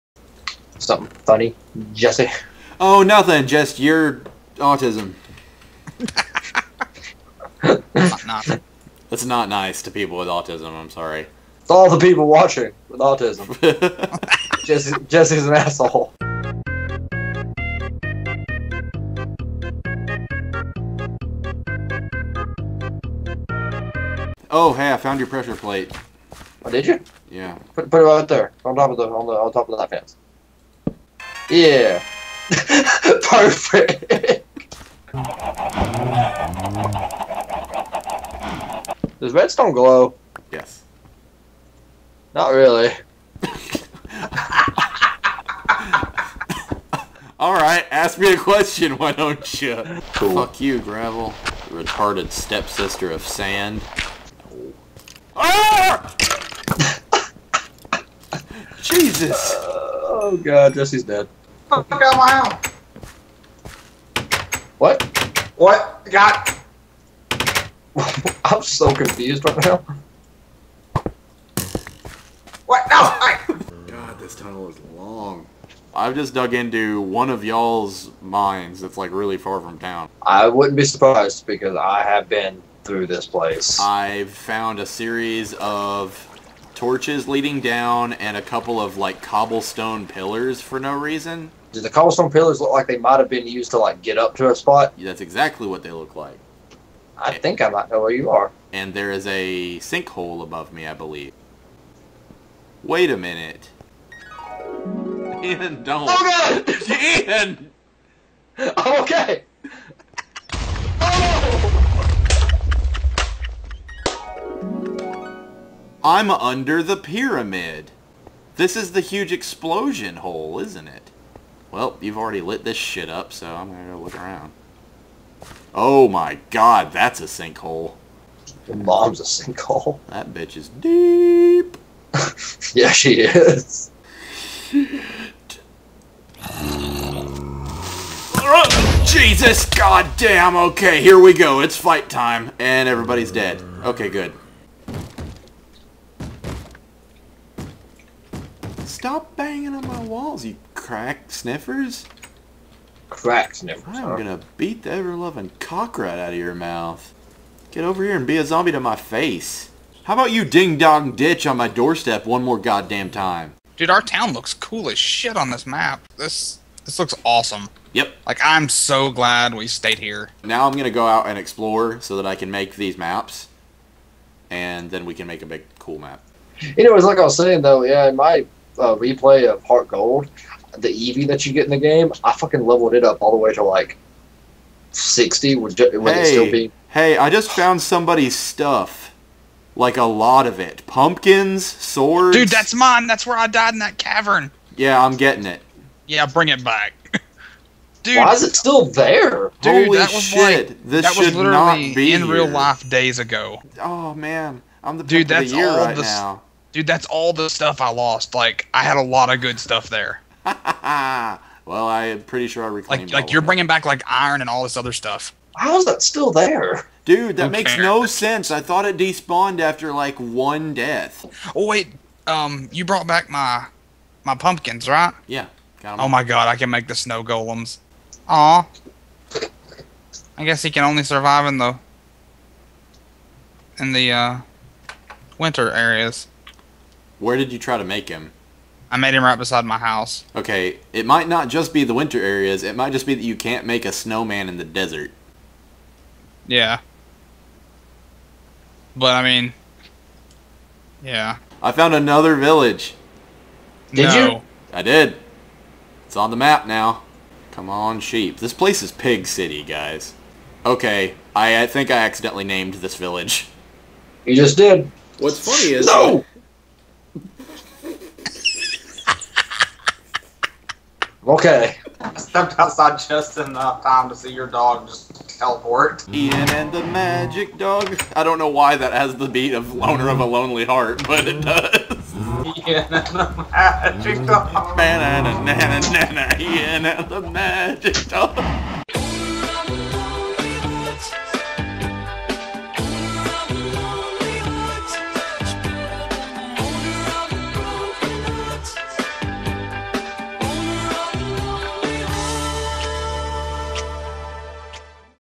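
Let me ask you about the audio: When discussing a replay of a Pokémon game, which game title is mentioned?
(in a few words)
HeartGold.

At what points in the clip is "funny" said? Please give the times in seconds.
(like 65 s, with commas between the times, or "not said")
1 s, 265 s.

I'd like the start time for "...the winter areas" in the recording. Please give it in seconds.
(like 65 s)
241 s.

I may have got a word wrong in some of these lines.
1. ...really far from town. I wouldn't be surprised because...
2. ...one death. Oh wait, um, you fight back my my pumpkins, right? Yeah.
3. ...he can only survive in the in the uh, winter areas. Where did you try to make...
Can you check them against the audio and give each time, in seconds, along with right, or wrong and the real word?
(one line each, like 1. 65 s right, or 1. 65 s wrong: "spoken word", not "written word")
1. 79 s right
2. 220 s wrong: "brought", not "fight"
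3. 230 s right.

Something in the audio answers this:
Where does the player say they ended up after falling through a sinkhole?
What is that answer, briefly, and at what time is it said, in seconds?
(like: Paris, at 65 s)
the pyramid, at 116 s.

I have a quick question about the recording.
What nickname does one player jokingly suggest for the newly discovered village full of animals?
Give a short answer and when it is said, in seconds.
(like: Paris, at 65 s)
Pig City, at 258 s.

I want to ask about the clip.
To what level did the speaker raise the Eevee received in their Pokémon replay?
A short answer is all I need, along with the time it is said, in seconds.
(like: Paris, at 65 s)
60, at 184 s.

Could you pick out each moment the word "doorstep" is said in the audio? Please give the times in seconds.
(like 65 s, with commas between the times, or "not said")
161 s.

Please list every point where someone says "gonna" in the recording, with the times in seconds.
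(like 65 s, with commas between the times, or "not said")
123 s, 154 s.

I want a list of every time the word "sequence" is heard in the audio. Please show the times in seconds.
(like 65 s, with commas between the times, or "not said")
not said.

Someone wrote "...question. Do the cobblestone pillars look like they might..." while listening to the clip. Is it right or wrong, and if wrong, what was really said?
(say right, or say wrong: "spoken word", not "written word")
wrong: "reason", not "question".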